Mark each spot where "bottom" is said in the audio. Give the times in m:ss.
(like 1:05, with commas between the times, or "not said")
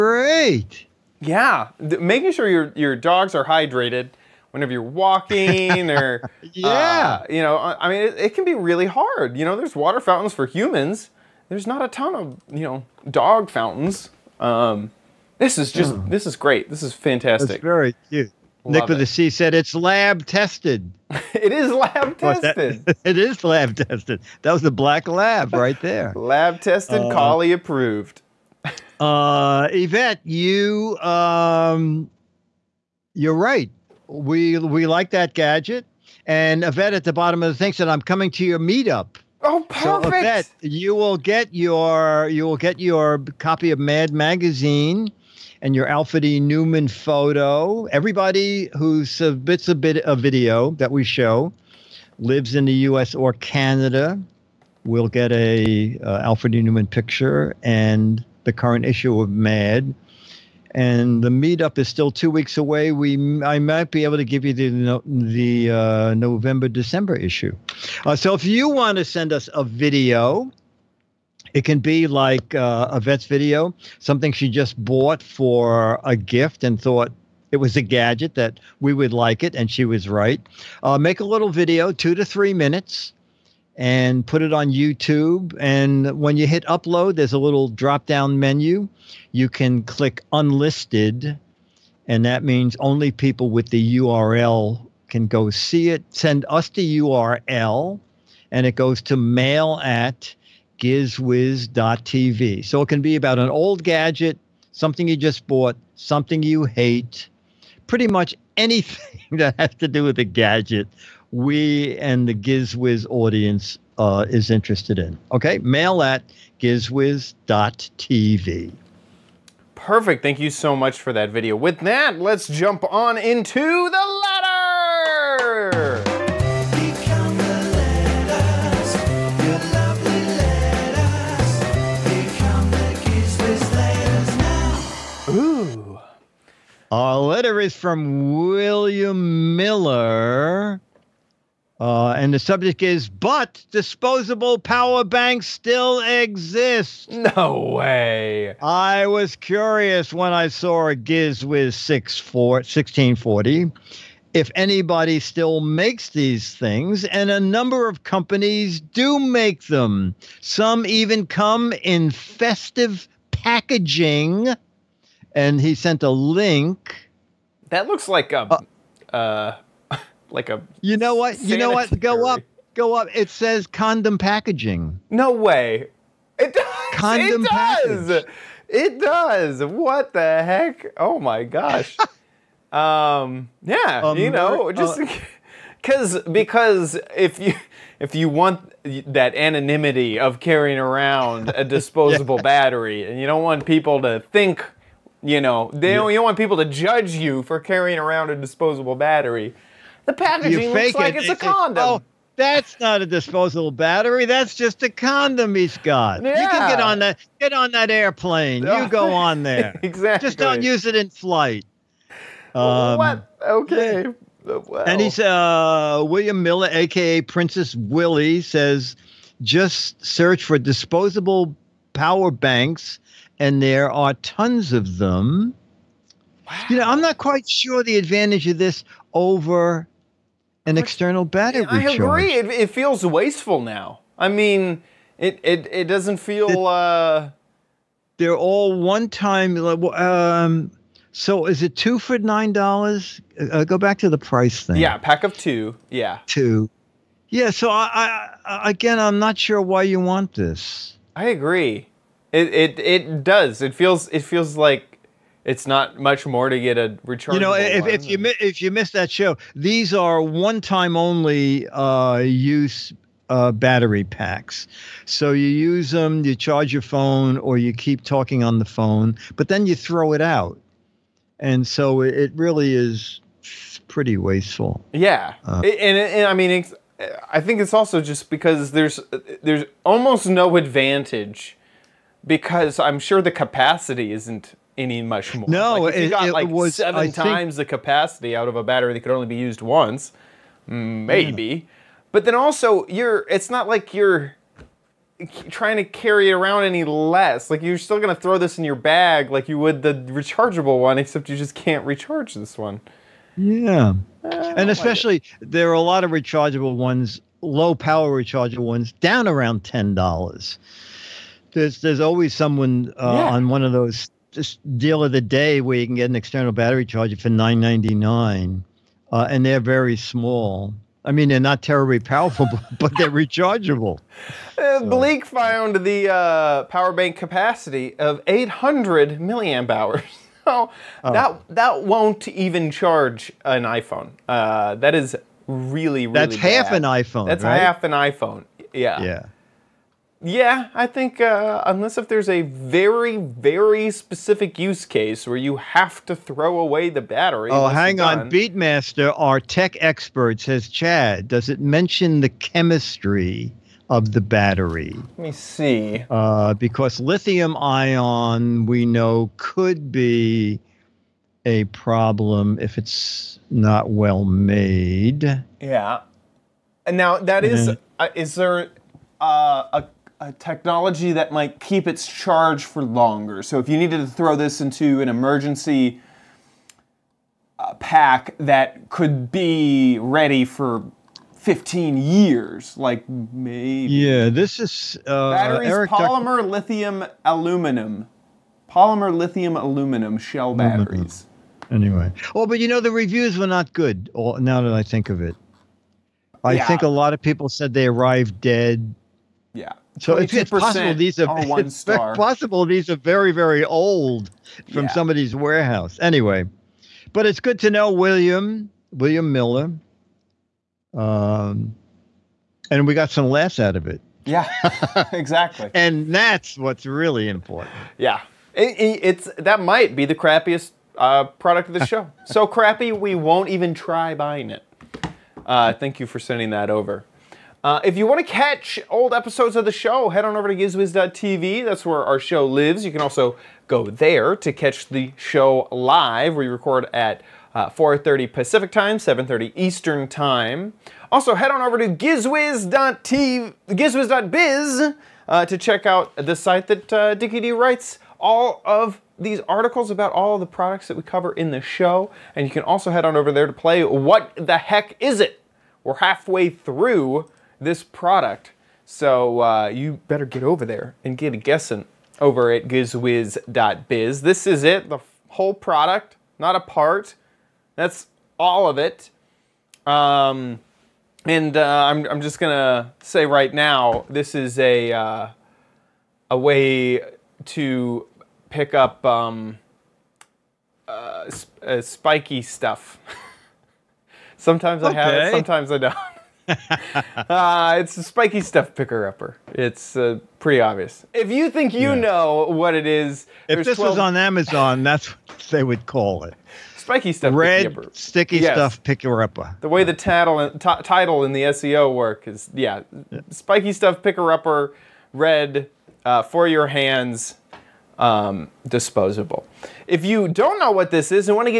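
0:37.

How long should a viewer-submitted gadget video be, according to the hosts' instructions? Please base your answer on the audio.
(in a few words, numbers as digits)
2 to 3 minutes.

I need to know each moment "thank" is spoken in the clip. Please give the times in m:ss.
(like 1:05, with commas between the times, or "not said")
2:00, 7:05.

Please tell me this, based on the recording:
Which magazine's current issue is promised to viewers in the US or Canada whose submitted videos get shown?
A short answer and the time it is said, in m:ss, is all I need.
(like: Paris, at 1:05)
Mad Magazine, at 0:43.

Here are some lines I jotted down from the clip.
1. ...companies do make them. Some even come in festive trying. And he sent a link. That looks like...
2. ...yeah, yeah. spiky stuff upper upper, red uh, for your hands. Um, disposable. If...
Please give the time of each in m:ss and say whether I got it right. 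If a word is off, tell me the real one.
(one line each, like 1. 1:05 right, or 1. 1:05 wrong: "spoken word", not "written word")
1. 2:38 wrong: "packaging", not "trying"
2. 8:22 wrong: "picker", not "upper".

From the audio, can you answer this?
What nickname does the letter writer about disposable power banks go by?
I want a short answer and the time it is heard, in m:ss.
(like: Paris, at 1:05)
Princess Willie, at 3:37.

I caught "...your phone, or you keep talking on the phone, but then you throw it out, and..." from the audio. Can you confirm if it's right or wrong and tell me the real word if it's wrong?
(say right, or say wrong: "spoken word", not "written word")
right.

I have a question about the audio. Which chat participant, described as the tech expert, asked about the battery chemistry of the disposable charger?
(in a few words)
Beatmaster.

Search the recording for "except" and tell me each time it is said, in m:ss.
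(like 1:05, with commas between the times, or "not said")
5:00.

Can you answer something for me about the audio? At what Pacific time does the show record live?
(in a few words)
4:30.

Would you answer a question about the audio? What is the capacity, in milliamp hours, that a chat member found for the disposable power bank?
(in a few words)
800 milliamp hours.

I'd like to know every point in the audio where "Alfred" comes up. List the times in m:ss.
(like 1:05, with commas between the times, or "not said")
0:45, 0:56.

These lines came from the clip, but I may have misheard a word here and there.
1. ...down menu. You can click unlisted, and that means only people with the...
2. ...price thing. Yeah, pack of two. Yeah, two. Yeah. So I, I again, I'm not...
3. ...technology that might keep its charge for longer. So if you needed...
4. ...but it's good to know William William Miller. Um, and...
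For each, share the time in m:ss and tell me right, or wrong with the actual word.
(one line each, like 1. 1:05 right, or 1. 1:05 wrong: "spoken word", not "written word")
1. 1:28 right
2. 4:04 right
3. 6:10 right
4. 6:47 right.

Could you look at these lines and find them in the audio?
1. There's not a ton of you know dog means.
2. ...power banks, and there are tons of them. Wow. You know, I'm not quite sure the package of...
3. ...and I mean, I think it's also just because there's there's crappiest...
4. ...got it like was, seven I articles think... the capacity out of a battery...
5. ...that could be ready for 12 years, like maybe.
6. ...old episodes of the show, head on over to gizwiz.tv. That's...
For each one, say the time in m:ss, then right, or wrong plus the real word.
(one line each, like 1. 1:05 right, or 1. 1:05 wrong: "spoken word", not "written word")
1. 0:11 wrong: "fountains", not "means"
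2. 3:41 wrong: "advantage", not "package"
3. 4:35 wrong: "almost", not "crappiest"
4. 4:46 wrong: "times", not "articles"
5. 6:18 wrong: "15", not "12"
6. 7:08 right.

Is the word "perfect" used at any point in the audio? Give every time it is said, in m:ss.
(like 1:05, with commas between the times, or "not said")
0:39, 1:59.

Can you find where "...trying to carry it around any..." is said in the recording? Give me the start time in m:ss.
4:55.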